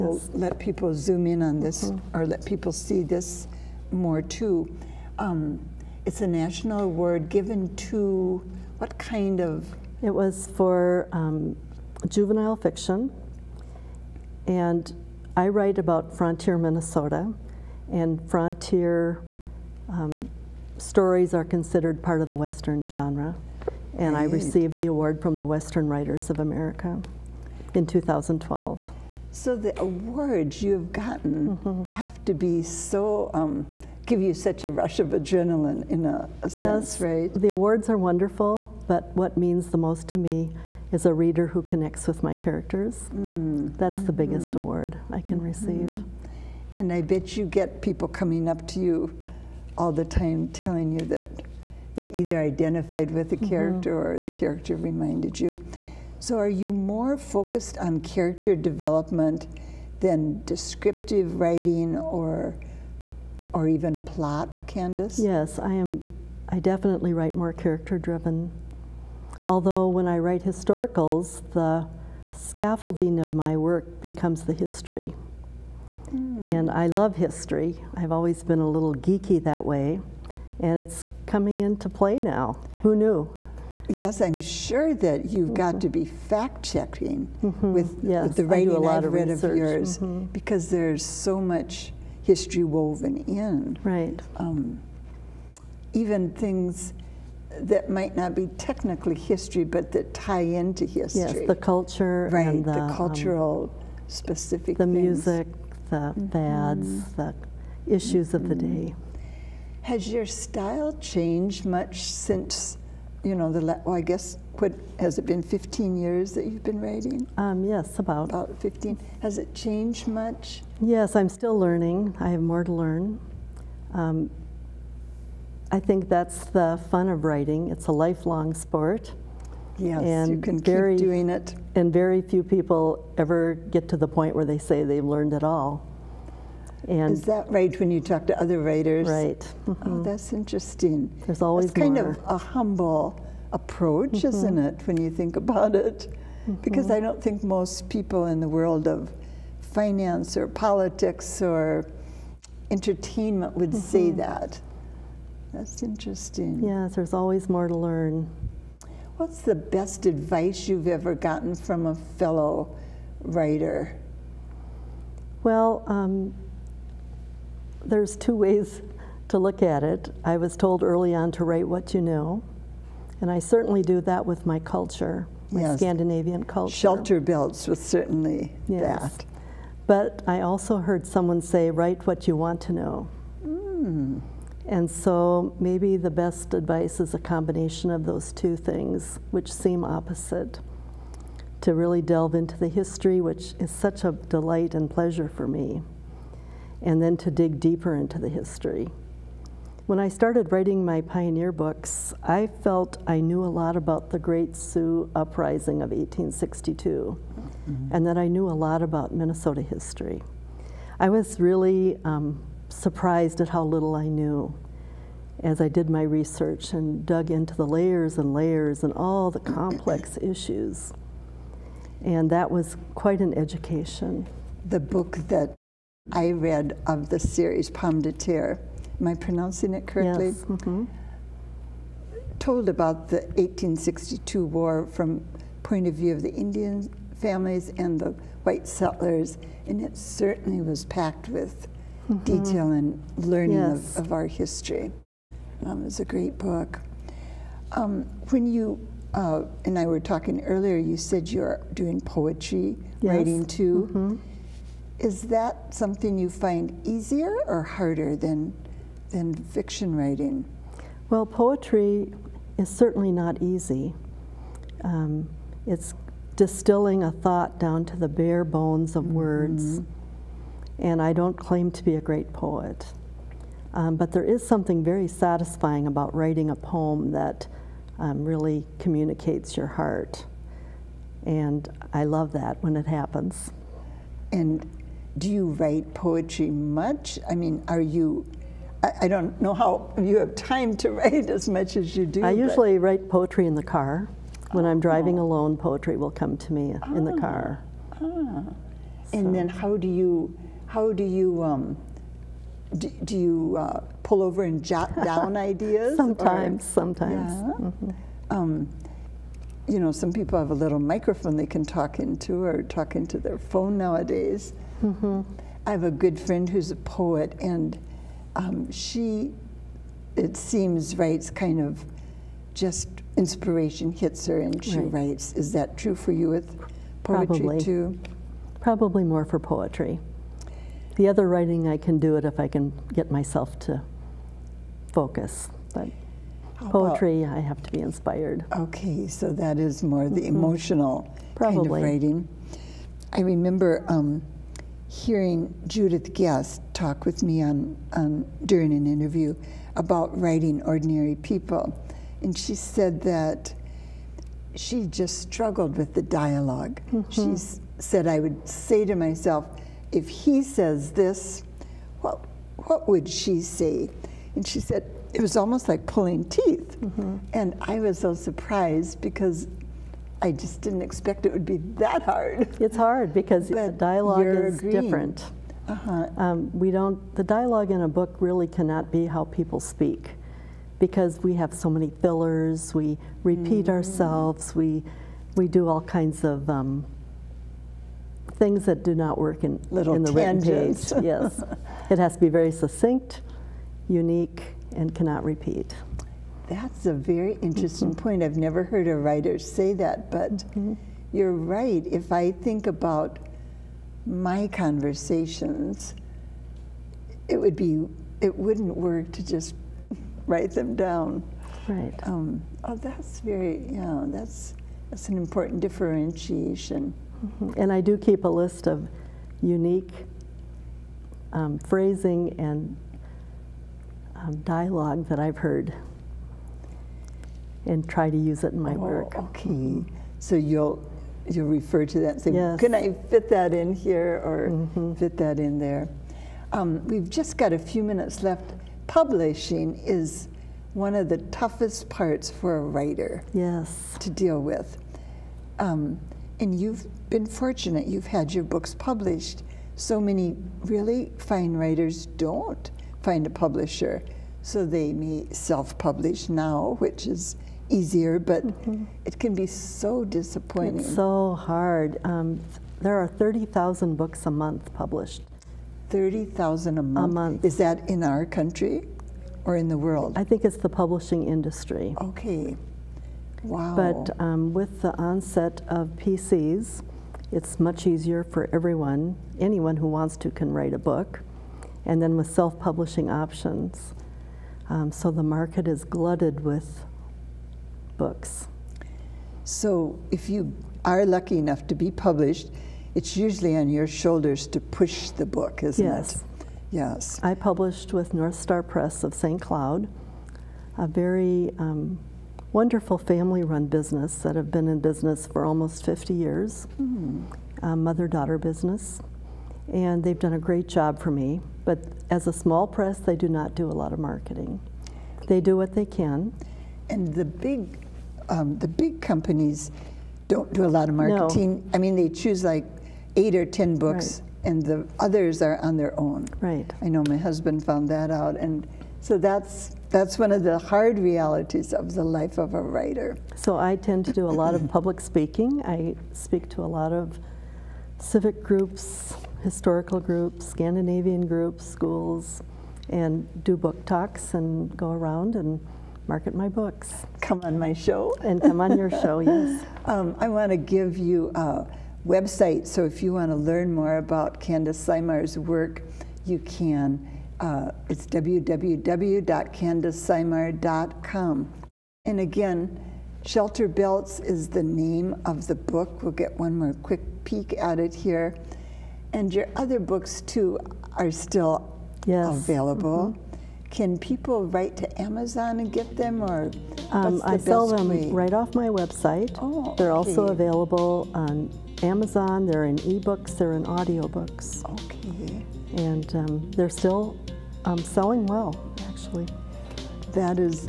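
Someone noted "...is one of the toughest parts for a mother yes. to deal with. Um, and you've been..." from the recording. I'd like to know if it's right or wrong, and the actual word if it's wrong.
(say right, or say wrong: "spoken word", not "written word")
wrong: "writer", not "mother".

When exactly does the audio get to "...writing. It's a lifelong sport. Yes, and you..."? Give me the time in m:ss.
2:07.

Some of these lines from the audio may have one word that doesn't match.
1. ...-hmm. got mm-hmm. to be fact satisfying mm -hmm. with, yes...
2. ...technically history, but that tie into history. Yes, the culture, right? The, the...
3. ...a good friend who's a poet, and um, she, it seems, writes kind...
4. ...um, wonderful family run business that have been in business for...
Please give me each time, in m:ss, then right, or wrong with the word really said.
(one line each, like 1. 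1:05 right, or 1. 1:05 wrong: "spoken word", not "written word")
1. 1:25 wrong: "checking", not "satisfying"
2. 1:38 right
3. 5:15 right
4. 8:21 right.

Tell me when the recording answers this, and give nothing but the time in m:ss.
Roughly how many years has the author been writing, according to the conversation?
1:58.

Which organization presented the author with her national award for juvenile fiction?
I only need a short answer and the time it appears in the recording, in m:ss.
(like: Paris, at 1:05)
Western Writers of America, at 0:25.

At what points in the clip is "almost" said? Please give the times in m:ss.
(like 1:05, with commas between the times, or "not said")
6:05, 8:25.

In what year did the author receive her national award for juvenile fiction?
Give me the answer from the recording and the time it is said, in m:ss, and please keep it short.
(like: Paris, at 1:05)
2012, at 0:27.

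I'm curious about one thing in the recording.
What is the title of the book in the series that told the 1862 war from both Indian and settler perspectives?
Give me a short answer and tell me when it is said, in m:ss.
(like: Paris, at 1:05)
Pomme de Terre, at 3:47.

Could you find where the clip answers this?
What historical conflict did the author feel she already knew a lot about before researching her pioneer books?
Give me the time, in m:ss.
3:24.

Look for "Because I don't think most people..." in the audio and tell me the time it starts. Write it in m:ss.
2:26.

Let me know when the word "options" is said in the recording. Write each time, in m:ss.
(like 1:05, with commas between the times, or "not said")
8:03.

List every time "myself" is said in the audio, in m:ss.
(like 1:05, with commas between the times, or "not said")
5:33, 5:58.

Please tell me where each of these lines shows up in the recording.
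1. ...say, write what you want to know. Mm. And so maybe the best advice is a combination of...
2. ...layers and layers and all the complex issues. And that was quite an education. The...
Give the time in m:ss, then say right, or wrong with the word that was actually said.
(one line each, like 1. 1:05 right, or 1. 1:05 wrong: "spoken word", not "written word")
1. 3:01 right
2. 3:37 right.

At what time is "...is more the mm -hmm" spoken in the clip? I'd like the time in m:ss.
5:39.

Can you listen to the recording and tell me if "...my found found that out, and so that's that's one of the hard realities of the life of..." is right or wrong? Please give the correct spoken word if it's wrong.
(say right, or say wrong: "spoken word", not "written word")
wrong: "husband", not "found".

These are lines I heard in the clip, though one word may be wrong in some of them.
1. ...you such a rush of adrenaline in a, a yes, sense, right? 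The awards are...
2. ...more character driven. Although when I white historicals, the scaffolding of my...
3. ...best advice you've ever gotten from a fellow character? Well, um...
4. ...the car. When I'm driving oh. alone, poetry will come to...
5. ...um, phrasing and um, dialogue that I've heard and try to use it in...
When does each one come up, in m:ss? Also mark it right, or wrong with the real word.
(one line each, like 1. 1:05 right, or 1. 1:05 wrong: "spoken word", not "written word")
1. 0:34 right
2. 1:07 wrong: "write", not "white"
3. 2:39 wrong: "writer", not "character"
4. 4:53 right
5. 7:01 right.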